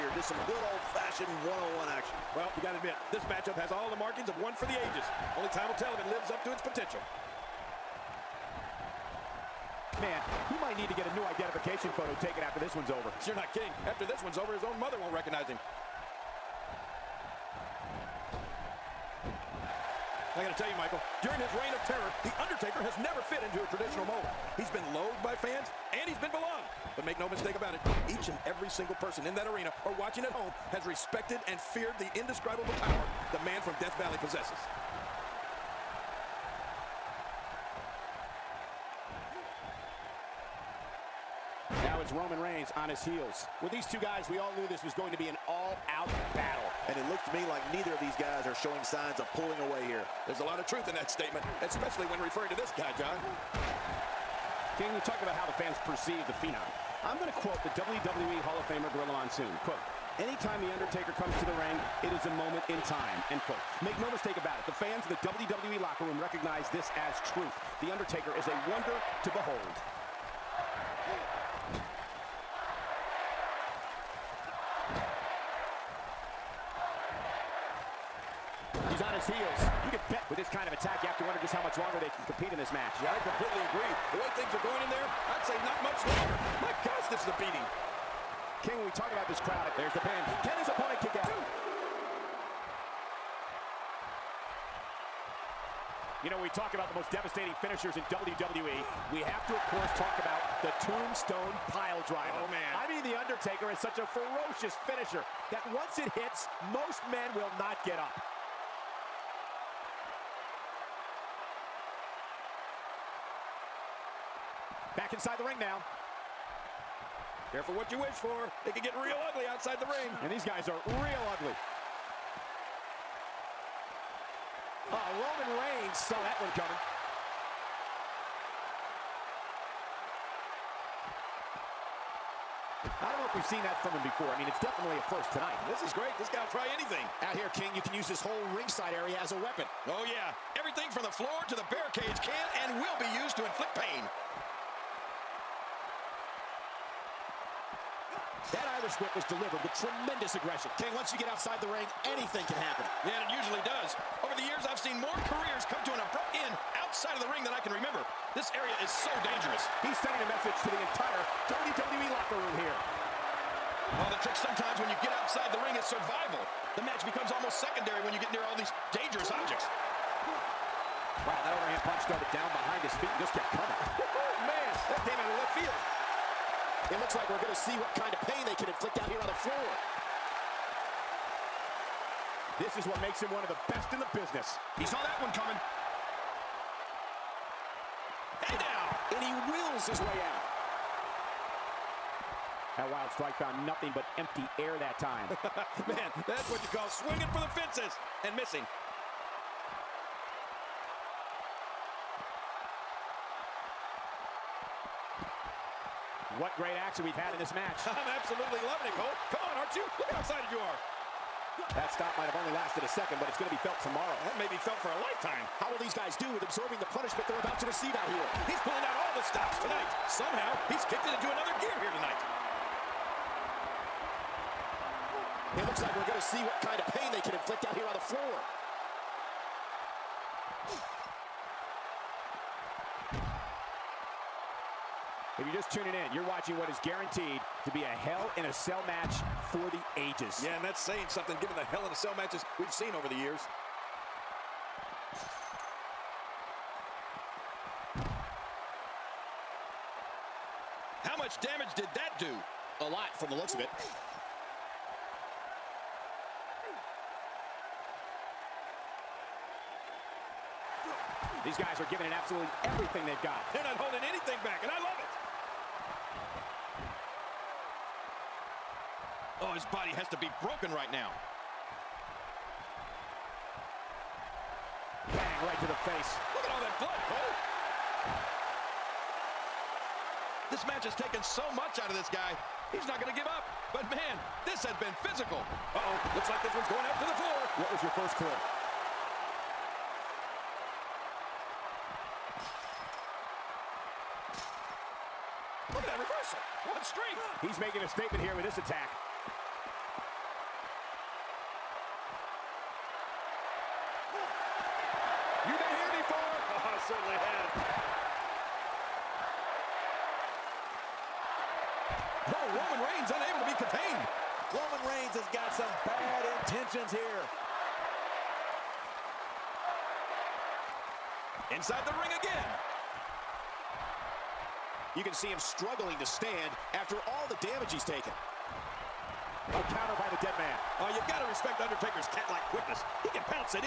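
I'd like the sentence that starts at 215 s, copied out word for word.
How will these guys do with absorbing the punishment they're about to receive out here?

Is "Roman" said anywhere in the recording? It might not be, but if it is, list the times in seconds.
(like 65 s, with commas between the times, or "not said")
42 s, 125 s.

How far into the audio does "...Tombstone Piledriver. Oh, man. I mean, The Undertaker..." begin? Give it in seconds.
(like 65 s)
100 s.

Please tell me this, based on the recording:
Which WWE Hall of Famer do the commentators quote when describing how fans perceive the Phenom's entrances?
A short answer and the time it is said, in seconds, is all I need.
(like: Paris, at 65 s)
Gorilla Monsoon, at 58 s.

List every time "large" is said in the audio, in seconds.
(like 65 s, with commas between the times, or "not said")
not said.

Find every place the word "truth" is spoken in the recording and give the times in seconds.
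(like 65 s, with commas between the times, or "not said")
50 s, 67 s.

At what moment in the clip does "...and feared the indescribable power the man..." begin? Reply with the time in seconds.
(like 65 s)
31 s.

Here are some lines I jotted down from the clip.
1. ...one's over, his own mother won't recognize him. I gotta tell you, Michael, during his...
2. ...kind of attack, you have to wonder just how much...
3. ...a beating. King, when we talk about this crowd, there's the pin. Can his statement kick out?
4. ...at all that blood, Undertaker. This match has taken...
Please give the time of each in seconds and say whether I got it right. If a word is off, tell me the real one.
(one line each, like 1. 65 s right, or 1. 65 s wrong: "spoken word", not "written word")
1. 14 s right
2. 80 s right
3. 87 s wrong: "opponent", not "statement"
4. 276 s wrong: "Cole", not "Undertaker".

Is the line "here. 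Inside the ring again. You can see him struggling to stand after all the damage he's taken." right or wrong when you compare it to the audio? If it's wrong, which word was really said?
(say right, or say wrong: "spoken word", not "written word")
right.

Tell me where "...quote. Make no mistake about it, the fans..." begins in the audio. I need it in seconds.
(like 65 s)
63 s.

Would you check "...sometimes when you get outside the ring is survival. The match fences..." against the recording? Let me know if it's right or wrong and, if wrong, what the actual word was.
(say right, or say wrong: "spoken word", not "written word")
wrong: "becomes", not "fences".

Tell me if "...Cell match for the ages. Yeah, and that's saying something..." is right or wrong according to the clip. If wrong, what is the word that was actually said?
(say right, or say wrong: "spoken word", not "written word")
right.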